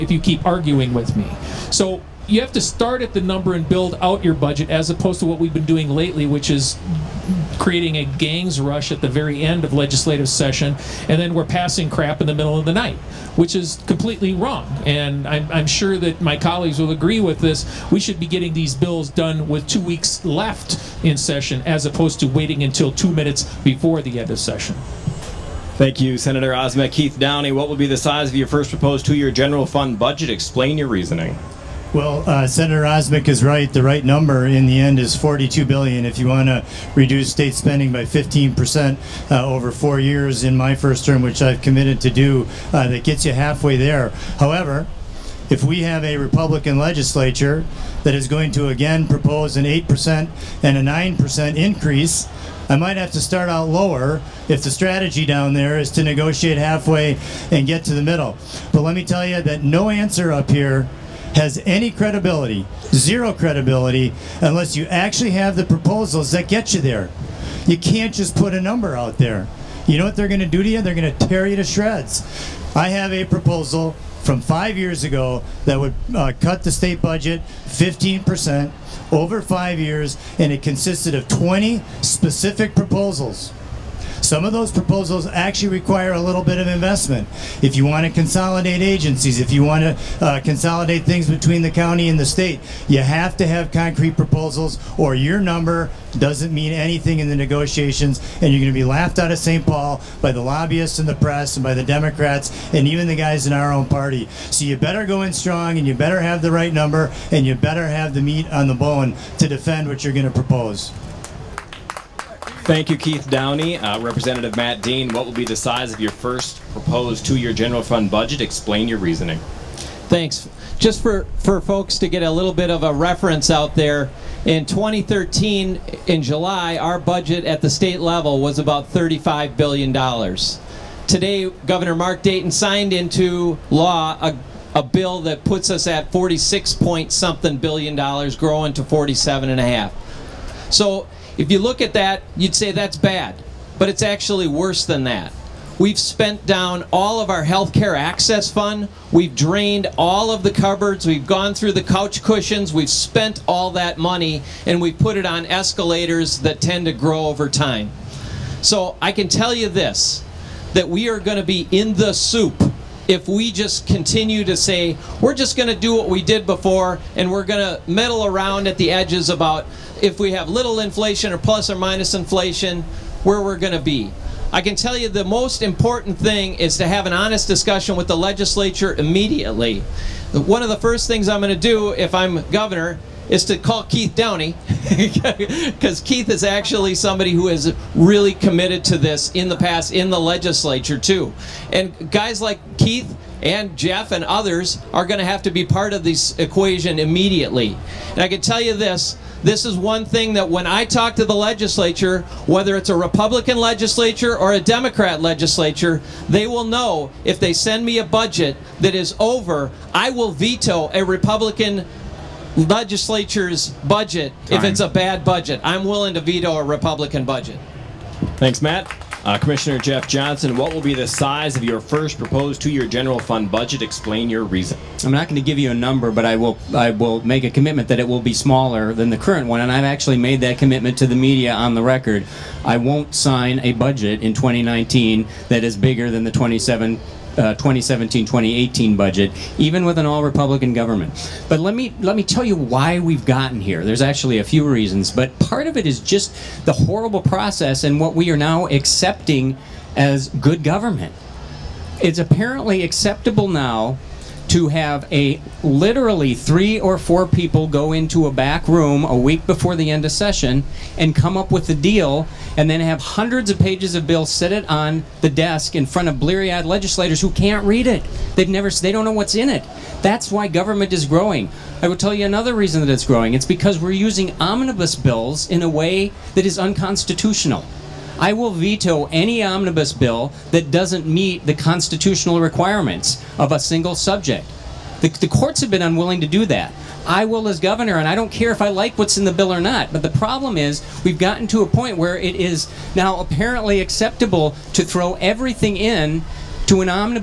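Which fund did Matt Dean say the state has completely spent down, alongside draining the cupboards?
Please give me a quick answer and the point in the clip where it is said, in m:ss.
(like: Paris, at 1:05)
healthcare access fund, at 2:27.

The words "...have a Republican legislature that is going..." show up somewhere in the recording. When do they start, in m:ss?
0:45.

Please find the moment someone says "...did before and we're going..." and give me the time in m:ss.
2:46.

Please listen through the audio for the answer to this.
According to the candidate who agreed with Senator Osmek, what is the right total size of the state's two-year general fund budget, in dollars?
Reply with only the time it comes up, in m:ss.
0:35.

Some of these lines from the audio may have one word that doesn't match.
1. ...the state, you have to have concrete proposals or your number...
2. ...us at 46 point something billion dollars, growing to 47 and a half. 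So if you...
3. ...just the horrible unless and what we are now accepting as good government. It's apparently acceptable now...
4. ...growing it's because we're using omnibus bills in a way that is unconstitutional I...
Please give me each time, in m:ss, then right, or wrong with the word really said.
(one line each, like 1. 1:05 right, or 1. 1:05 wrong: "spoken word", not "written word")
1. 1:32 right
2. 2:15 right
3. 4:05 wrong: "process", not "unless"
4. 4:33 right.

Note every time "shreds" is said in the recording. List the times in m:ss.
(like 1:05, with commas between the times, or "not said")
1:11.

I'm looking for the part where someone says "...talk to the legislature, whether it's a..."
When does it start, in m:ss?
3:20.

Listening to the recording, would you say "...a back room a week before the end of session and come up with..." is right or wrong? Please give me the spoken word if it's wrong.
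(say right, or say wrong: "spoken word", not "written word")
right.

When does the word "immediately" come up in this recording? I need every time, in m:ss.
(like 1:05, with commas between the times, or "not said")
2:58, 3:16.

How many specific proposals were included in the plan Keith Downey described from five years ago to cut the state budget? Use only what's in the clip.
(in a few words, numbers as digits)
20.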